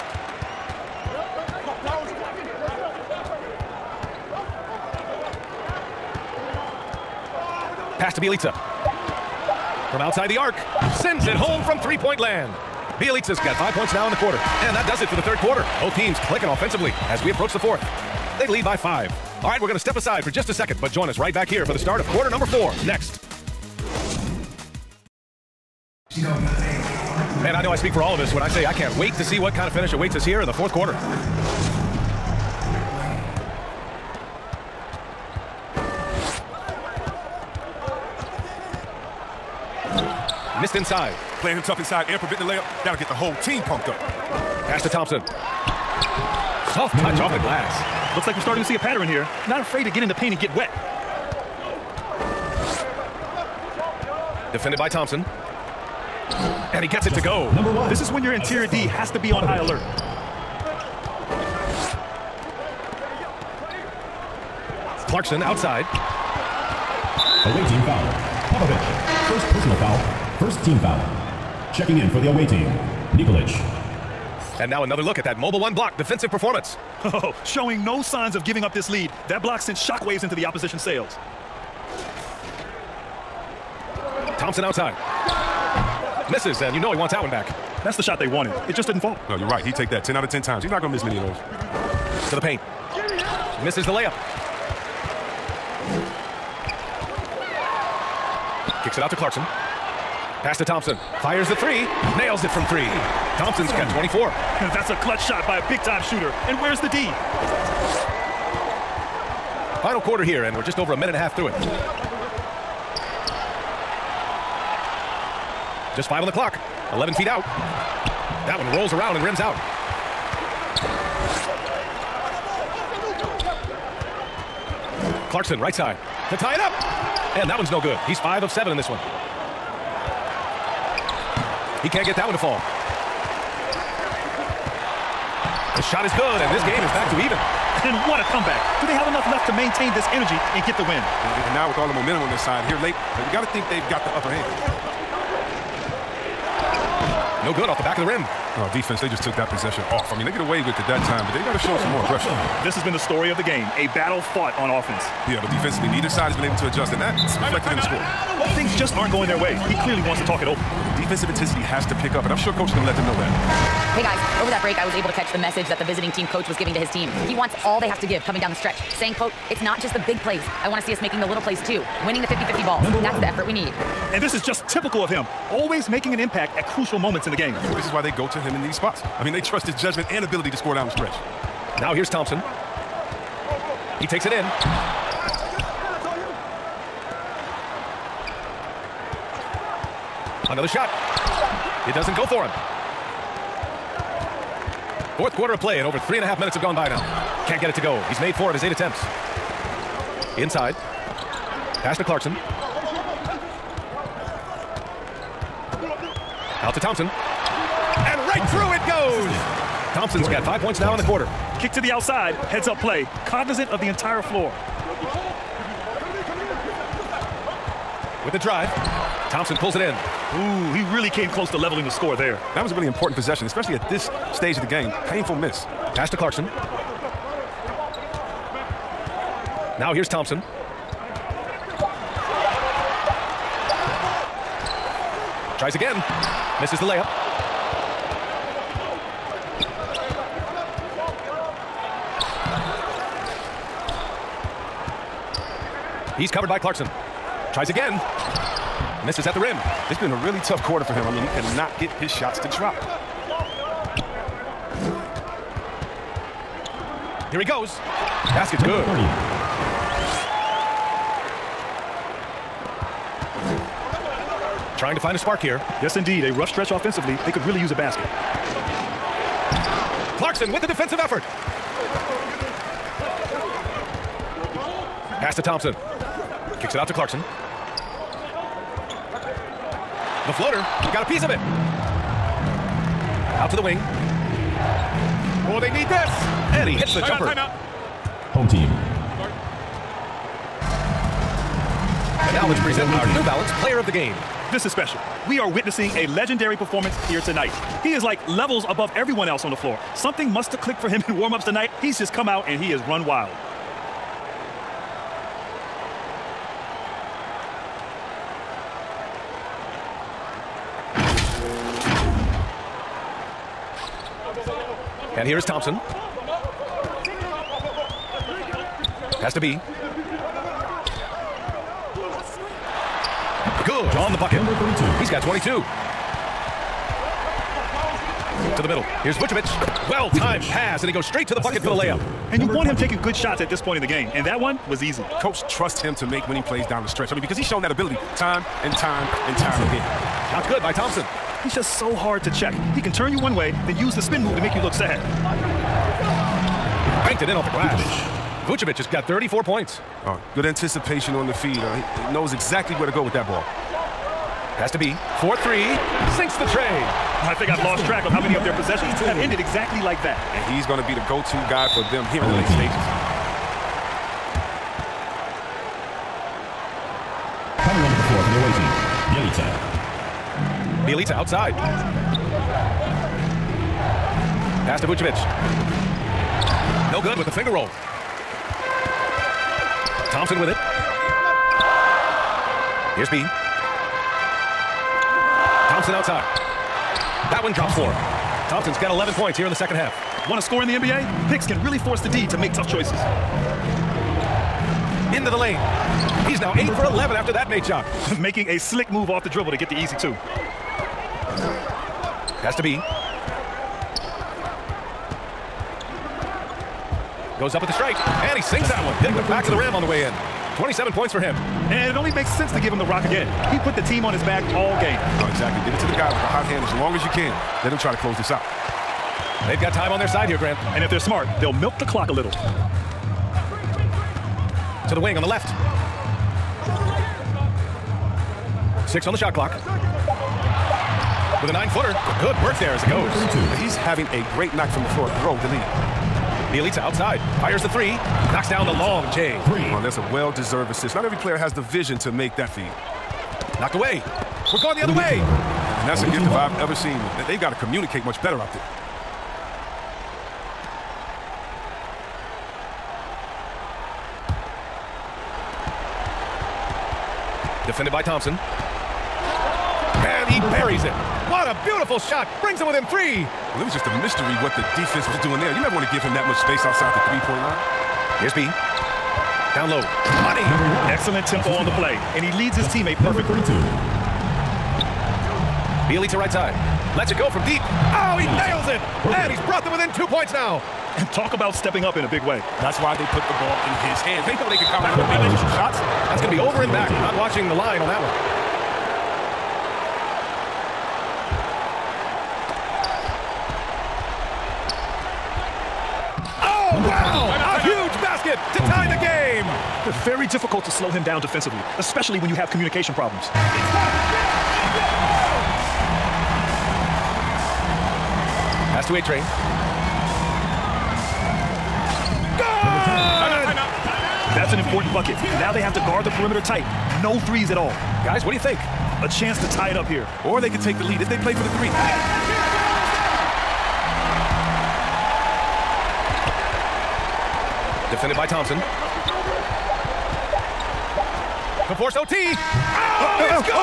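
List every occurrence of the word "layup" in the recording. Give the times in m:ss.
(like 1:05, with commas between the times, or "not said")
0:42, 1:33, 3:56, 5:31.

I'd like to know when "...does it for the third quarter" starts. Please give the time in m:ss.
0:14.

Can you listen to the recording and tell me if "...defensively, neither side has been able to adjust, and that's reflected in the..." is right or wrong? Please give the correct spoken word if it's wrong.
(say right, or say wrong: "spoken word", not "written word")
right.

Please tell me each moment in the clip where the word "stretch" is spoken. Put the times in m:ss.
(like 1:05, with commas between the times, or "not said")
2:48, 3:00, 4:26, 5:36.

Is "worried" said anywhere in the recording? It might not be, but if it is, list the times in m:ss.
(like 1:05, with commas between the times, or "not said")
not said.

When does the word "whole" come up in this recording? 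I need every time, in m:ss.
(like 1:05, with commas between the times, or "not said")
0:43.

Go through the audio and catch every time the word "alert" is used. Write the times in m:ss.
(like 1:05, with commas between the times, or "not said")
0:59.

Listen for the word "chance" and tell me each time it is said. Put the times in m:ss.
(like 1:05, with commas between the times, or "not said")
8:39.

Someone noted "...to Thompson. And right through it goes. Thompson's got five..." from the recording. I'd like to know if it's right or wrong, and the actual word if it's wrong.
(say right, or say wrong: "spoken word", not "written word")
right.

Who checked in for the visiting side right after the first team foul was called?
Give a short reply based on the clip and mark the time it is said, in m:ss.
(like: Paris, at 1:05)
Nikolic, at 1:13.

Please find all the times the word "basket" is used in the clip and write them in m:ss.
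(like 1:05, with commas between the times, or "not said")
4:18, 4:27.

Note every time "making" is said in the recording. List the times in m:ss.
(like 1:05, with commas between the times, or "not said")
2:51, 2:55, 6:38.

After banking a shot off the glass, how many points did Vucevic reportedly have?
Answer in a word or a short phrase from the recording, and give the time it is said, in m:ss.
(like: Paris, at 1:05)
34, at 5:49.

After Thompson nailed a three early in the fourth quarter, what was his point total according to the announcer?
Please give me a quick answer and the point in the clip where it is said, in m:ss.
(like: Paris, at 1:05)
24, at 1:43.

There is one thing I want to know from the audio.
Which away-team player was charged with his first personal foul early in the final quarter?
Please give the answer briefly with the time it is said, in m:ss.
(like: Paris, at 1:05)
Popovich, at 1:08.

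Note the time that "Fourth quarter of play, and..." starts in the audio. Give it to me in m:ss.
3:15.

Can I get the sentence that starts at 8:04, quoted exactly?
They know they can count on the to shots.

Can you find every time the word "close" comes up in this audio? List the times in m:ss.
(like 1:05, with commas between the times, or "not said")
3:41, 6:58.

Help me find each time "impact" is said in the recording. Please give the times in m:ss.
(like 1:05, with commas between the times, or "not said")
2:56.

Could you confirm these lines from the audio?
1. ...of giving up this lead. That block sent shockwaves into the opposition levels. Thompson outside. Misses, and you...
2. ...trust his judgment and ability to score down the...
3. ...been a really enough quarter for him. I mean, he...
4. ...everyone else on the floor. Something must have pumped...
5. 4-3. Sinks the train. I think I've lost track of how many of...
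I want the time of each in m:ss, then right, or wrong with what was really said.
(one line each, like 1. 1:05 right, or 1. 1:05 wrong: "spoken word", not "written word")
1. 1:18 wrong: "sails", not "levels"
2. 2:59 right
3. 4:09 wrong: "tough", not "enough"
4. 4:58 wrong: "clicked", not "pumped"
5. 5:55 right.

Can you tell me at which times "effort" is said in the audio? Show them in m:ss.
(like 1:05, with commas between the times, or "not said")
2:53, 4:30.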